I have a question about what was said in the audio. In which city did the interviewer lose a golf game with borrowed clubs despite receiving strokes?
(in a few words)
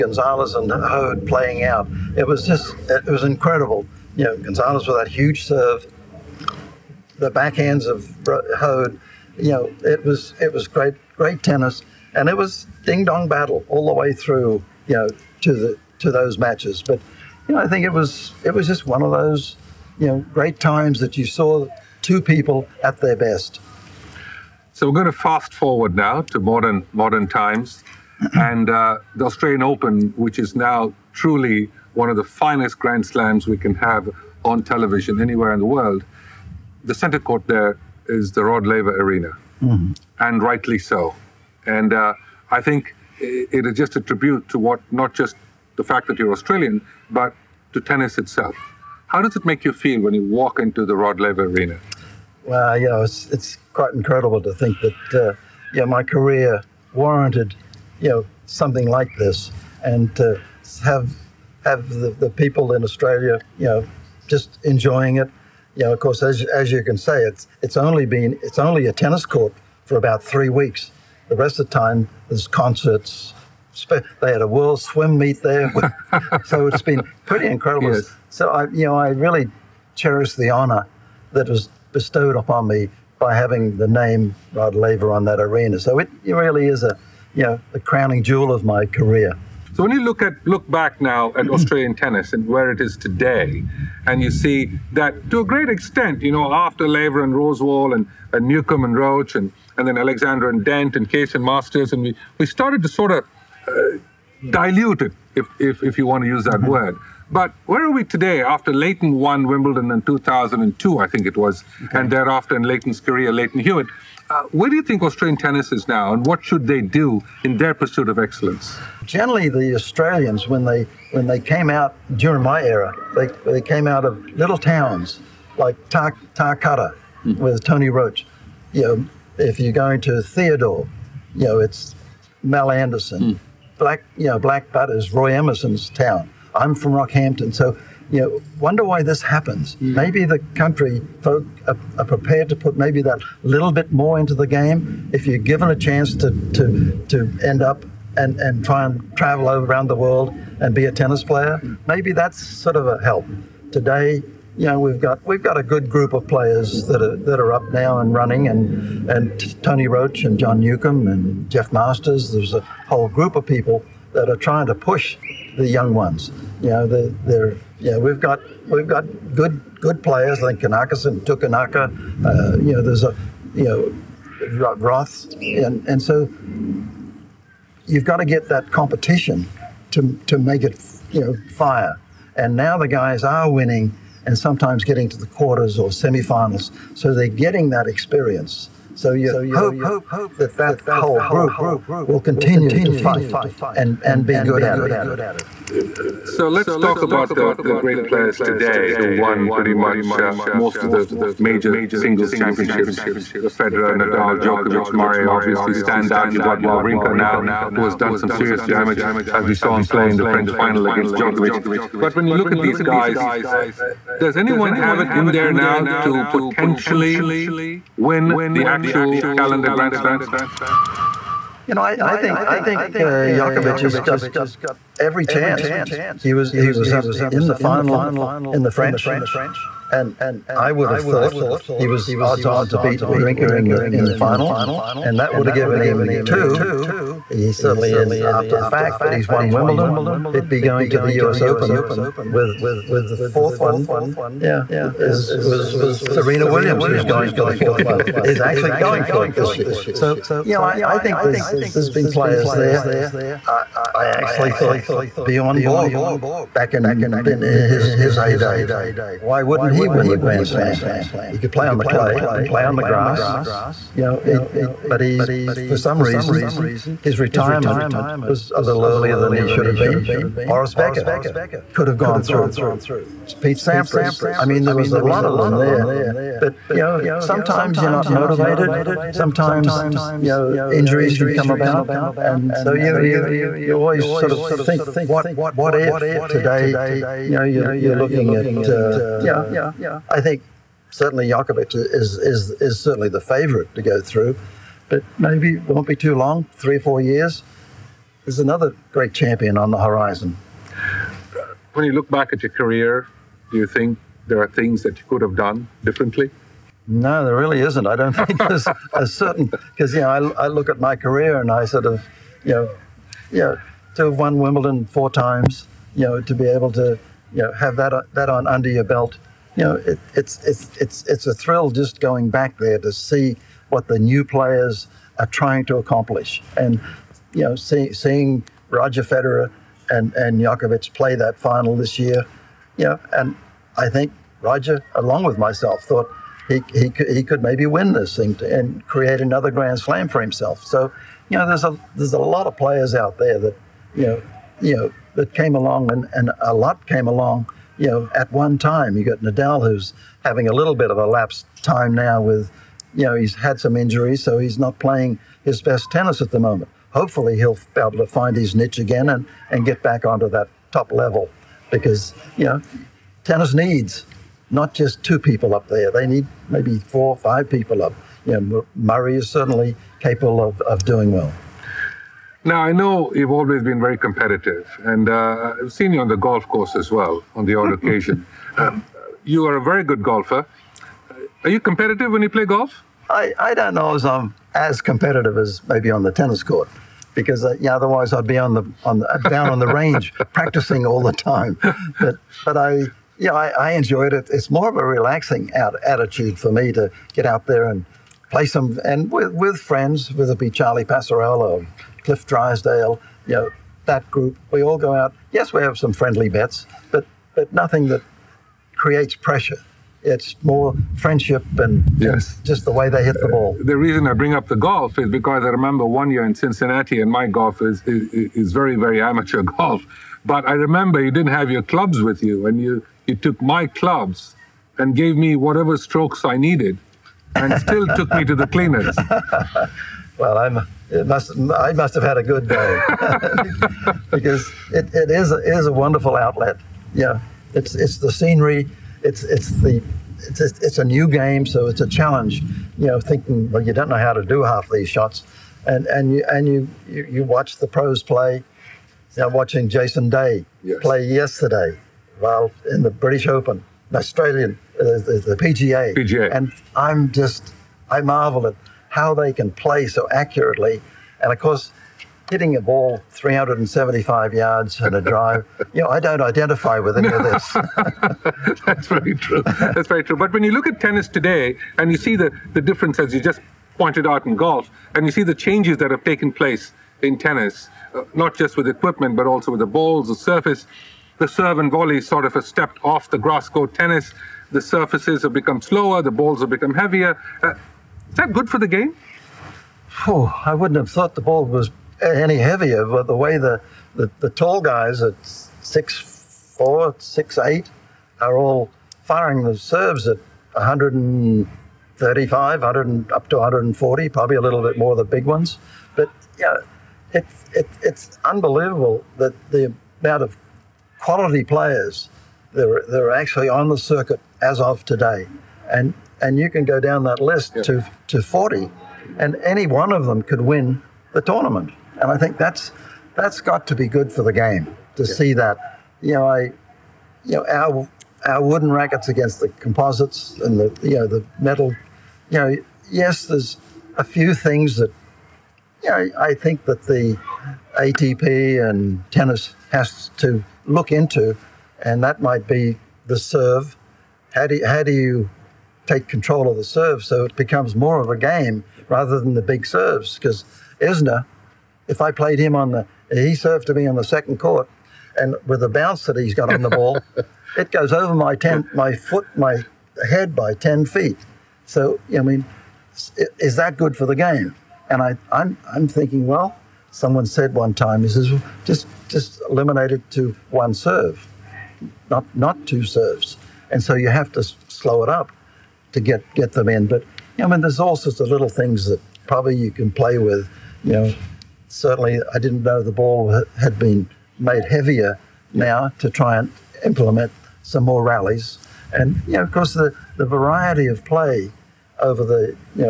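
Cincinnati.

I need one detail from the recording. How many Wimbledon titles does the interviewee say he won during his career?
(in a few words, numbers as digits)
4.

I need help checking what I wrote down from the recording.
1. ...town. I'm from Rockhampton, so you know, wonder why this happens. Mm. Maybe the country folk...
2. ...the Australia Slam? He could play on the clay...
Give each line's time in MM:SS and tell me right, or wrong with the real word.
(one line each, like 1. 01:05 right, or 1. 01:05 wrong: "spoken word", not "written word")
1. 02:15 right
2. 04:20 wrong: "Grand", not "Australia".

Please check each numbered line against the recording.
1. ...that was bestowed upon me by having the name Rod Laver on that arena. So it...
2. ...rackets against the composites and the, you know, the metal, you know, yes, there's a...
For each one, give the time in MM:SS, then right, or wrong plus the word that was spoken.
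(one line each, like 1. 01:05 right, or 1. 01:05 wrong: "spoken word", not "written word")
1. 01:21 right
2. 08:48 right.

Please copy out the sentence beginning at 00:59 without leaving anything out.
And to have have the, the people in Australia, you know, just enjoying it.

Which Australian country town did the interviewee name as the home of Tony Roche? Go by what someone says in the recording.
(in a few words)
Tarcutta.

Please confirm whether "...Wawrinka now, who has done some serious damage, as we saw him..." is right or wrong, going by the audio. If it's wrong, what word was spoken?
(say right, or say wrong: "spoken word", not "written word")
right.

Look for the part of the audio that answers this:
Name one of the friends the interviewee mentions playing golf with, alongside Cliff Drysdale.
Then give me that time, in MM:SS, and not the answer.
06:40.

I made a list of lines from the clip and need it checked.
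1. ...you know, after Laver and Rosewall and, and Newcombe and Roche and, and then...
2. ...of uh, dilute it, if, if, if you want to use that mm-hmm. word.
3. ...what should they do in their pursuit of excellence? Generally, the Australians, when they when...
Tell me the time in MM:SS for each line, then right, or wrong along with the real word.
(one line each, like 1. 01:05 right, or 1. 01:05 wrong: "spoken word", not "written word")
1. 01:36 right
2. 01:43 right
3. 01:56 right.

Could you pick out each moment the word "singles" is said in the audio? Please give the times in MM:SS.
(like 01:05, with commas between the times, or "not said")
03:21.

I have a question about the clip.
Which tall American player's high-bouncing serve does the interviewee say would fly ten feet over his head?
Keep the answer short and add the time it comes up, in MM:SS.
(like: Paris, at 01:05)
Isner, at 09:10.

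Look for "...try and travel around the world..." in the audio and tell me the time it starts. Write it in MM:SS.
02:28.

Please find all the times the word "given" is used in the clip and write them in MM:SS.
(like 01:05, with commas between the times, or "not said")
02:25, 03:55.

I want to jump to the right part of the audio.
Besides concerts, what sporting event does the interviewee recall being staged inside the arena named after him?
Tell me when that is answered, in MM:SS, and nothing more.
01:14.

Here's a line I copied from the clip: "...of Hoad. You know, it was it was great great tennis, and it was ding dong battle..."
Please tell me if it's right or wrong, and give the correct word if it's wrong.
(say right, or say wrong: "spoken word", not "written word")
right.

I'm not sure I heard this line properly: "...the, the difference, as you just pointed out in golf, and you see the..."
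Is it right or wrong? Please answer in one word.
right.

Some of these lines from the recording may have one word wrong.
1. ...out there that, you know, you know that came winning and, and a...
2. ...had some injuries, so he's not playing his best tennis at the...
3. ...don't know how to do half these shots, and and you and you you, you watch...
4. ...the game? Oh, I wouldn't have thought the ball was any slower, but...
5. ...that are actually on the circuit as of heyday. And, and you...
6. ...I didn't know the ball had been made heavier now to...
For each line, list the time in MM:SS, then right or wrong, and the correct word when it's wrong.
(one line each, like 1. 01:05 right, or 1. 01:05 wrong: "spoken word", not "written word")
1. 05:42 wrong: "along", not "winning"
2. 05:53 right
3. 07:23 right
4. 08:08 wrong: "heavier", not "slower"
5. 08:32 wrong: "today", not "heyday"
6. 09:42 right.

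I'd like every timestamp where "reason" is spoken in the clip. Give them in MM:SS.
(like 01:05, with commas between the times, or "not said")
04:26, 06:53.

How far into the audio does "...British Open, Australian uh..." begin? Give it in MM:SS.
07:32.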